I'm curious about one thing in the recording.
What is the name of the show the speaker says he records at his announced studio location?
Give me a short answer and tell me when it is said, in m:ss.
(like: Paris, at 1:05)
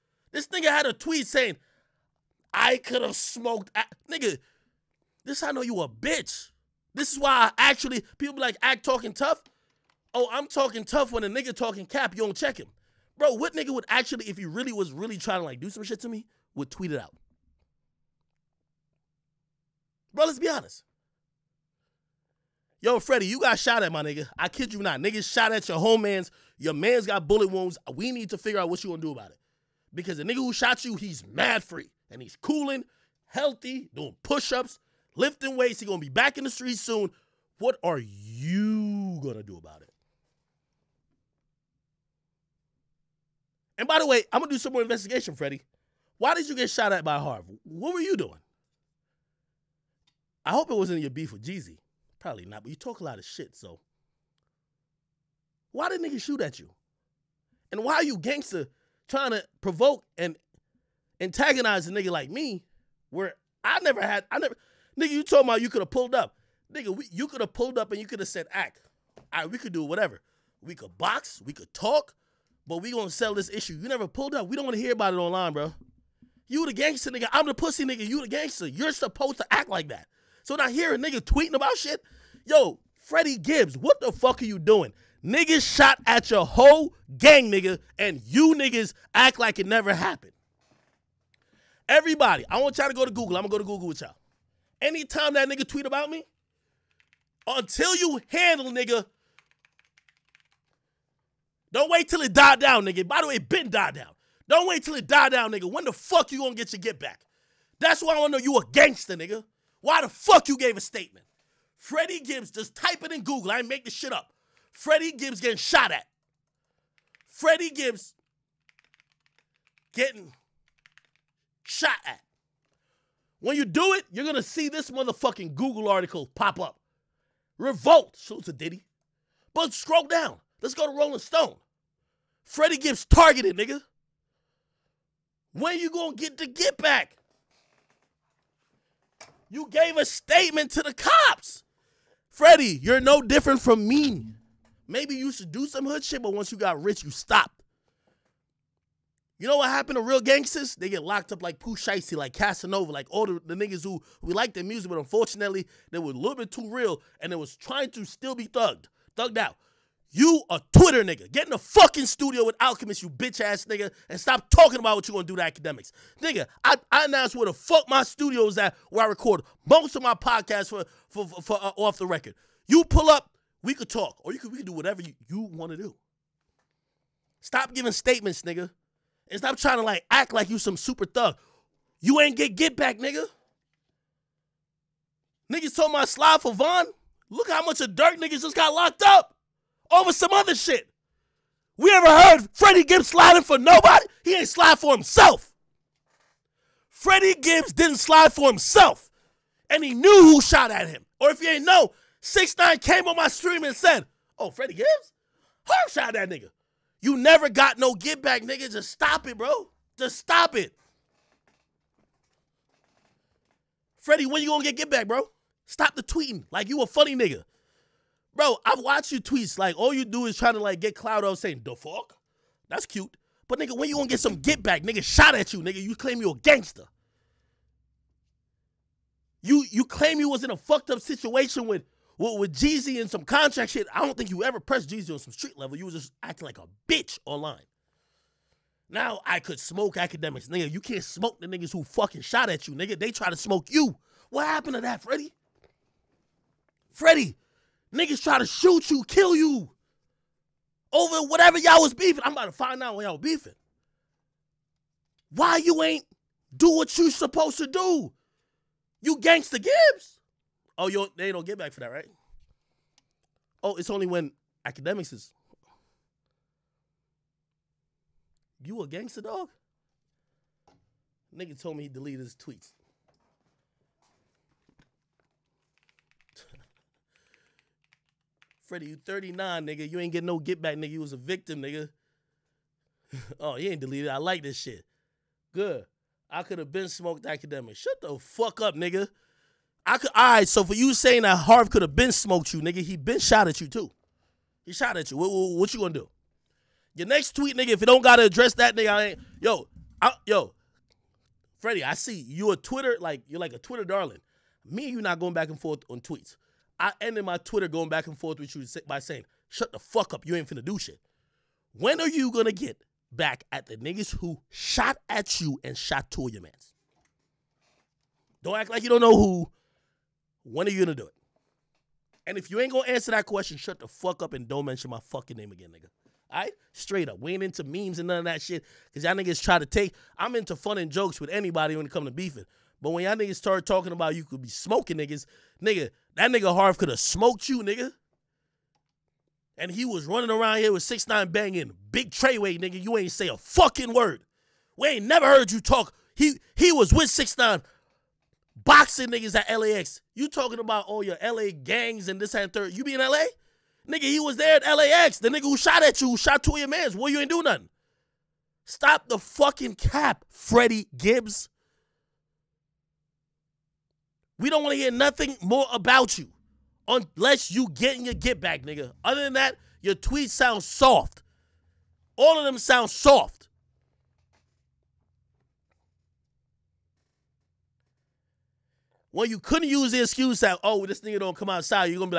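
Off the Record, at 2:51.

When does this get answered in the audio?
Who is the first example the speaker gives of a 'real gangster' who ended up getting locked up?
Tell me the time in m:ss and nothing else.
2:31.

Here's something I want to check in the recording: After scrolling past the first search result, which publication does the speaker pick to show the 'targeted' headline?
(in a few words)
Rolling Stone.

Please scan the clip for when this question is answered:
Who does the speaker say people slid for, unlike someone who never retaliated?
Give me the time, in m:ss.
3:06.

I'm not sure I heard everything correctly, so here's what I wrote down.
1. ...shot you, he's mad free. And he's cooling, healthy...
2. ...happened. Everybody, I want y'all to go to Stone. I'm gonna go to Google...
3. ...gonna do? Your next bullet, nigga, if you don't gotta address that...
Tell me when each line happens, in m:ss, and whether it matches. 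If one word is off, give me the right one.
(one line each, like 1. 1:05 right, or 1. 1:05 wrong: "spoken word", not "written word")
1. 0:30 right
2. 1:29 wrong: "Google", not "Stone"
3. 4:55 wrong: "tweet", not "bullet".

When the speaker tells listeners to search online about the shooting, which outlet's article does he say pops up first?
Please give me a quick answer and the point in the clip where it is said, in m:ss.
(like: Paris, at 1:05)
Revolt, at 2:07.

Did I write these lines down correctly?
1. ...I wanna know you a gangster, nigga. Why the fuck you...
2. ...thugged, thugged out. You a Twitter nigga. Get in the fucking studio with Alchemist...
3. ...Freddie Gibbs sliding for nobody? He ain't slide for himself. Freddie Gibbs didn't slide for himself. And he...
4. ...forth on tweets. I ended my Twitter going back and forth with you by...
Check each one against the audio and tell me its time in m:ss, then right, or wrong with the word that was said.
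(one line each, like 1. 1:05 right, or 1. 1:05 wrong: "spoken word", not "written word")
1. 1:48 right
2. 2:38 right
3. 3:12 right
4. 5:05 right.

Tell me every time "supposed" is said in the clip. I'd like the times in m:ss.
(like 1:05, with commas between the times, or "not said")
1:18, 4:17.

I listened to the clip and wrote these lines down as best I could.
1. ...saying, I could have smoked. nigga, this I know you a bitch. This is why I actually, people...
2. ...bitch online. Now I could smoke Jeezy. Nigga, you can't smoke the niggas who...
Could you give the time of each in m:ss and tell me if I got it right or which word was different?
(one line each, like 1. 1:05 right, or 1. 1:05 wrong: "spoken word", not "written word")
1. 0:01 right
2. 3:56 wrong: "Akademiks", not "Jeezy".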